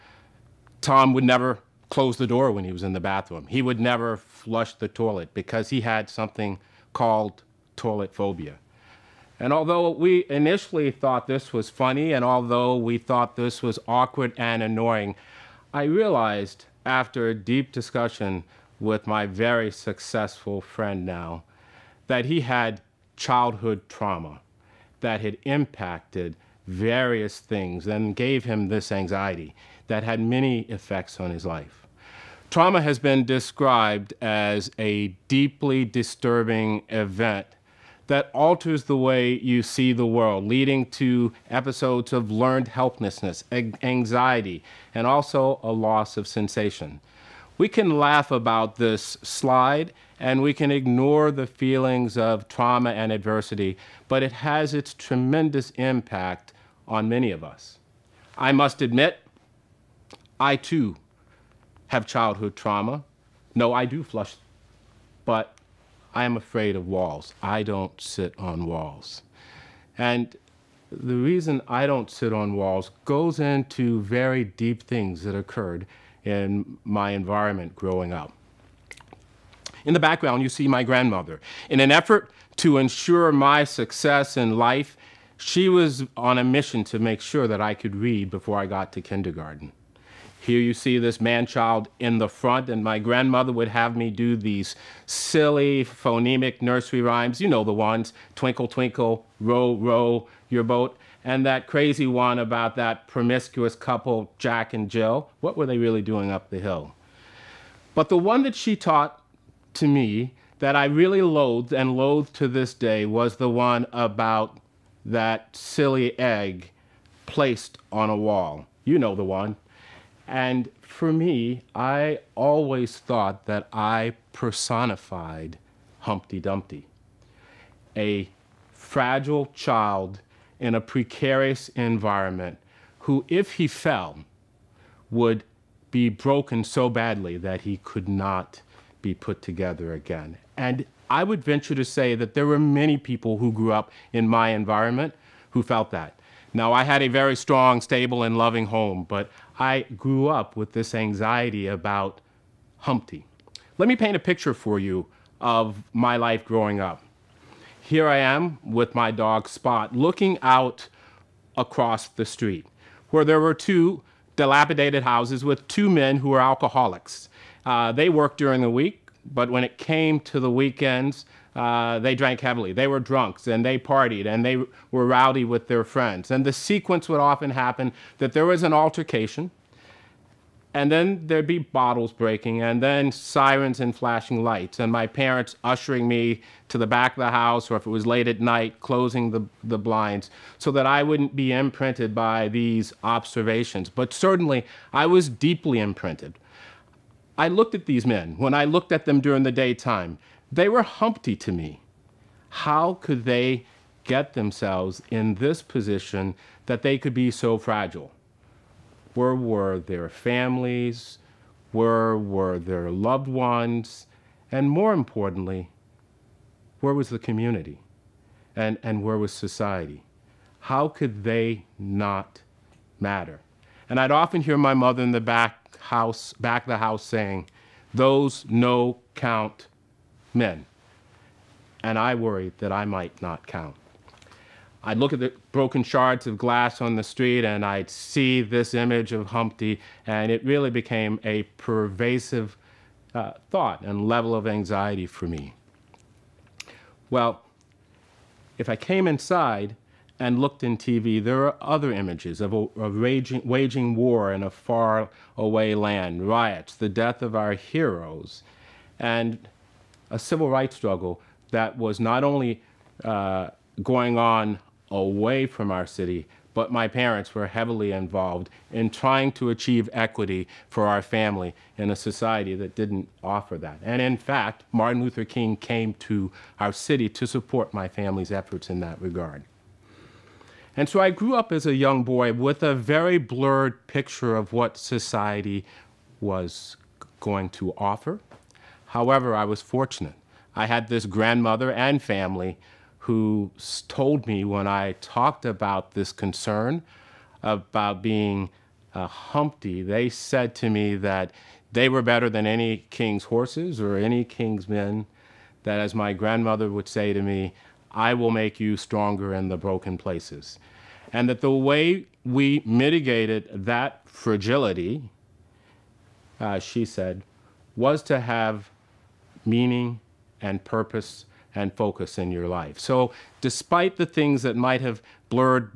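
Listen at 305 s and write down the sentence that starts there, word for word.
That, as my grandmother would say to me, I will make you stronger in the broken places.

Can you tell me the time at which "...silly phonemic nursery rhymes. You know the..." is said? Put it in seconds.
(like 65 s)
95 s.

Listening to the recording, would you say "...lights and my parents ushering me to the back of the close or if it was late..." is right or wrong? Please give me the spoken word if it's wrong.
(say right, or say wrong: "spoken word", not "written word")
wrong: "house", not "close".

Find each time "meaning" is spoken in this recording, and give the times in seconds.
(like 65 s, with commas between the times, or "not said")
319 s.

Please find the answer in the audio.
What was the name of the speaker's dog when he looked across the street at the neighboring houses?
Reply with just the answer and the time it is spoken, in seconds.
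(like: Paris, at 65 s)
Spot, at 159 s.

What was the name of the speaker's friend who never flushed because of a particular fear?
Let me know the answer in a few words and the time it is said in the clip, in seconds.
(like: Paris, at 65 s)
Tom, at 0 s.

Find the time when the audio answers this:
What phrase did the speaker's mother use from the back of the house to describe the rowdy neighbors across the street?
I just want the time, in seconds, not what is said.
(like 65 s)
228 s.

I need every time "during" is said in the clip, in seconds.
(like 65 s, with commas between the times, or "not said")
168 s, 199 s.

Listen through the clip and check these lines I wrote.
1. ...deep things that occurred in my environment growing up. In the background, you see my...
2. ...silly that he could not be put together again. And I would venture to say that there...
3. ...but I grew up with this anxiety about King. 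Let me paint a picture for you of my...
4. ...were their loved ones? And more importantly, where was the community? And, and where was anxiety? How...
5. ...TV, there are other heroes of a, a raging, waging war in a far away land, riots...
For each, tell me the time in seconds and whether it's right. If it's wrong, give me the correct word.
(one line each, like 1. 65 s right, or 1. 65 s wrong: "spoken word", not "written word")
1. 74 s right
2. 136 s wrong: "badly", not "silly"
3. 149 s wrong: "Humpty", not "King"
4. 212 s wrong: "society", not "anxiety"
5. 250 s wrong: "images", not "heroes".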